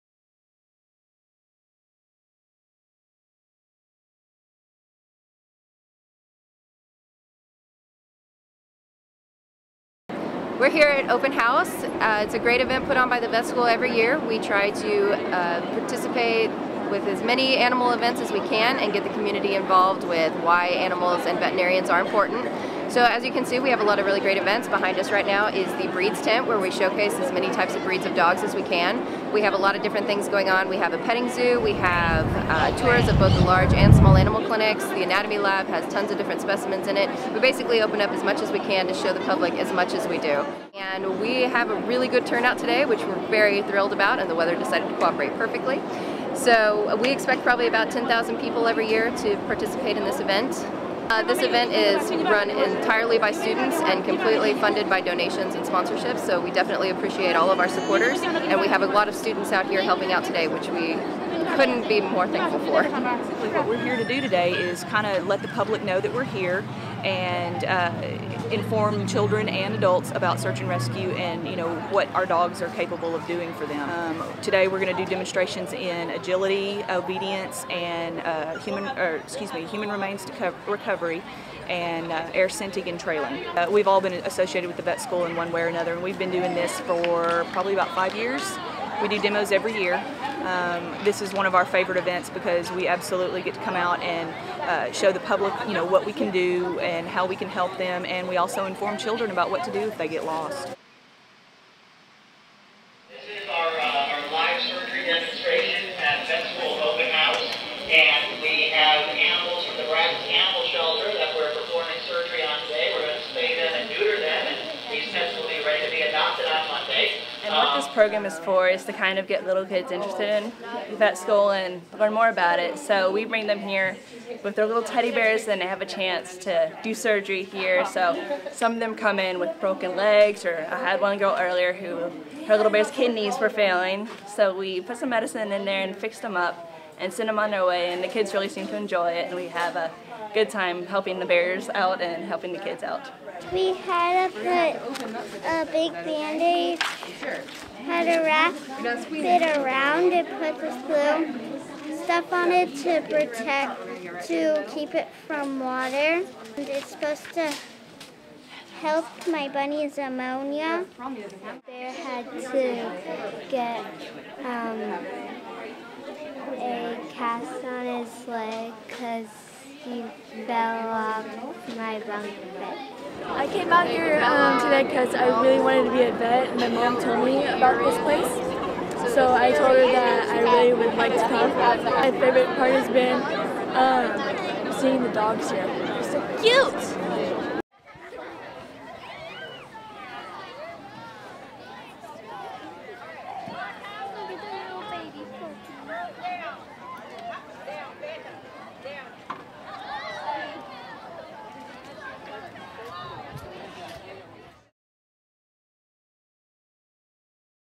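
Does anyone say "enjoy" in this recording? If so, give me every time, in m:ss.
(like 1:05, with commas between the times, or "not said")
2:18.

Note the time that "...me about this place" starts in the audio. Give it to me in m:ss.
2:57.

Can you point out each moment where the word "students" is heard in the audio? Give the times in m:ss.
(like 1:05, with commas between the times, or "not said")
0:53, 0:59.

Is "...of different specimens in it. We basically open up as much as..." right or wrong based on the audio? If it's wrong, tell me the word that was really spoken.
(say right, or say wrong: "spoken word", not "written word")
right.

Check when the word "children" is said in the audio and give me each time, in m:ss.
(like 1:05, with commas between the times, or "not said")
1:09, 1:38.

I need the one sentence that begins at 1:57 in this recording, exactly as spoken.
And what this program is for is to kind of get little kids interested in vet school and learn more about it.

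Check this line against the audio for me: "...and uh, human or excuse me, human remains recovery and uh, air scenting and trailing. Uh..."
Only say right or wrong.
right.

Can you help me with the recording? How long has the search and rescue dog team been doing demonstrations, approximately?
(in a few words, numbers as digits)
about five years.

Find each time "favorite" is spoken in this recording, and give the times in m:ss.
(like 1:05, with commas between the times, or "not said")
1:31, 3:02.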